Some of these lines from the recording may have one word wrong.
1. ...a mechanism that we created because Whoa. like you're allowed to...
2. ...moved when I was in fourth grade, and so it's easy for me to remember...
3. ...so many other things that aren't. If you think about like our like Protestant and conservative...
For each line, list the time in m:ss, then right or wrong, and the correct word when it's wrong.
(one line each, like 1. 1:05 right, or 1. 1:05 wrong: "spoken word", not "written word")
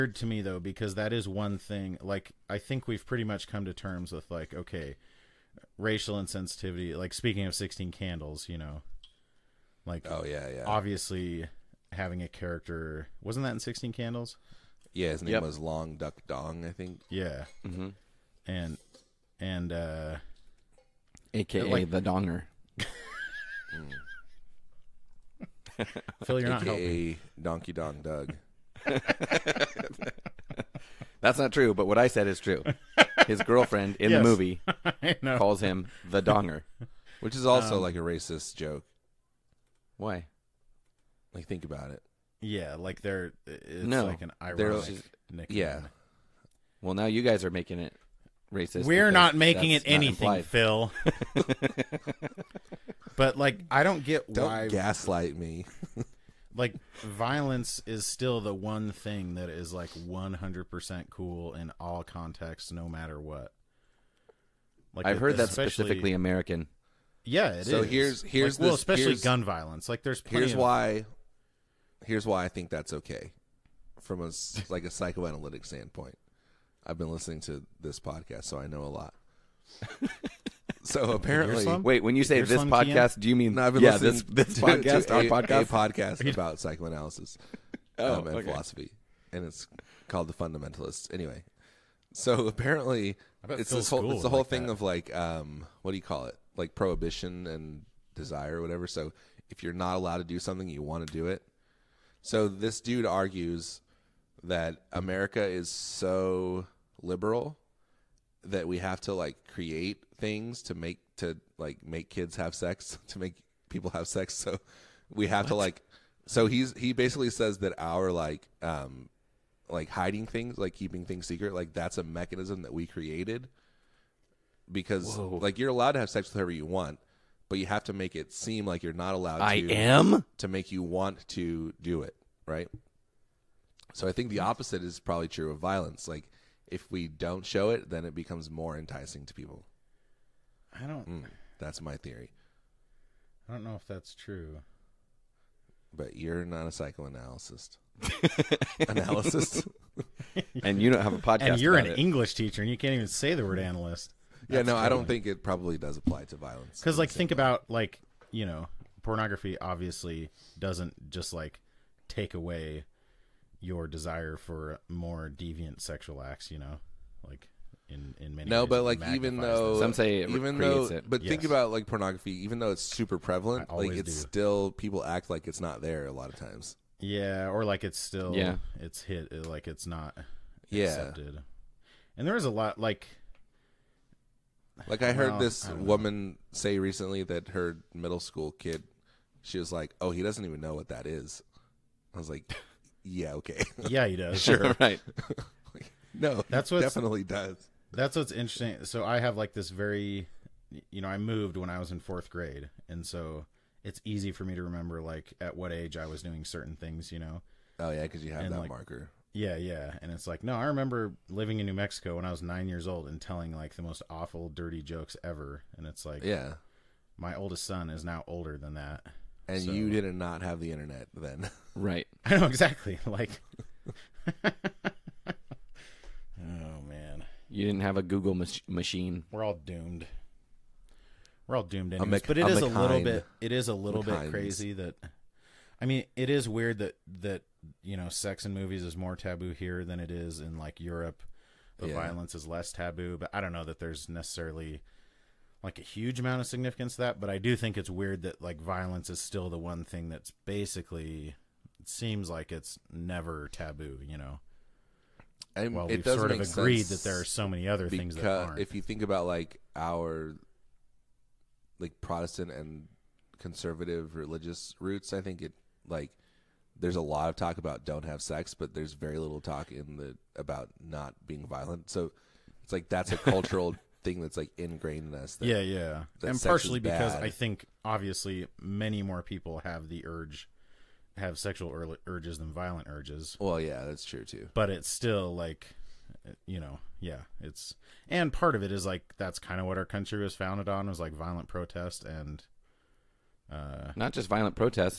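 1. 2:01 right
2. 3:21 right
3. 4:17 right.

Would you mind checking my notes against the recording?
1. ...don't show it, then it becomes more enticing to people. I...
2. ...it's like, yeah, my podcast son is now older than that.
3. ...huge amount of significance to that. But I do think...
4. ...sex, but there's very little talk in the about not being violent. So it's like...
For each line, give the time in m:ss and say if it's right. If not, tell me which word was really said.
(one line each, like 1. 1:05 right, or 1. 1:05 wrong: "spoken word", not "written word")
1. 2:17 right
2. 3:35 wrong: "oldest", not "podcast"
3. 4:05 right
4. 4:28 right.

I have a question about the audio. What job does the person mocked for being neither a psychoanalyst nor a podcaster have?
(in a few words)
English teacher.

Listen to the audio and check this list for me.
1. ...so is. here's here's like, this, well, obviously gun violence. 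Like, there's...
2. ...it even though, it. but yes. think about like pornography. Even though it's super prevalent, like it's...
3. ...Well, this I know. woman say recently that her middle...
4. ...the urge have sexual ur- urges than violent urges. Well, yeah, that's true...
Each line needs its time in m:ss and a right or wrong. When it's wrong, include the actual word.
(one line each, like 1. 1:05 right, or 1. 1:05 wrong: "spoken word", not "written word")
1. 1:07 wrong: "especially", not "obviously"
2. 2:50 right
3. 3:05 right
4. 4:39 right.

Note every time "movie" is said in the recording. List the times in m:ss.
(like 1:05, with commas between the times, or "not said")
0:34, 3:58.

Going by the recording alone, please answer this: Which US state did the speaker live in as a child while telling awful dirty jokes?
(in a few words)
New Mexico.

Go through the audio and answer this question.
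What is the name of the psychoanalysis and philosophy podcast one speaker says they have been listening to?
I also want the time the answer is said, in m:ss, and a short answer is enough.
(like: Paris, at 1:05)
The Fundamentalists, at 1:30.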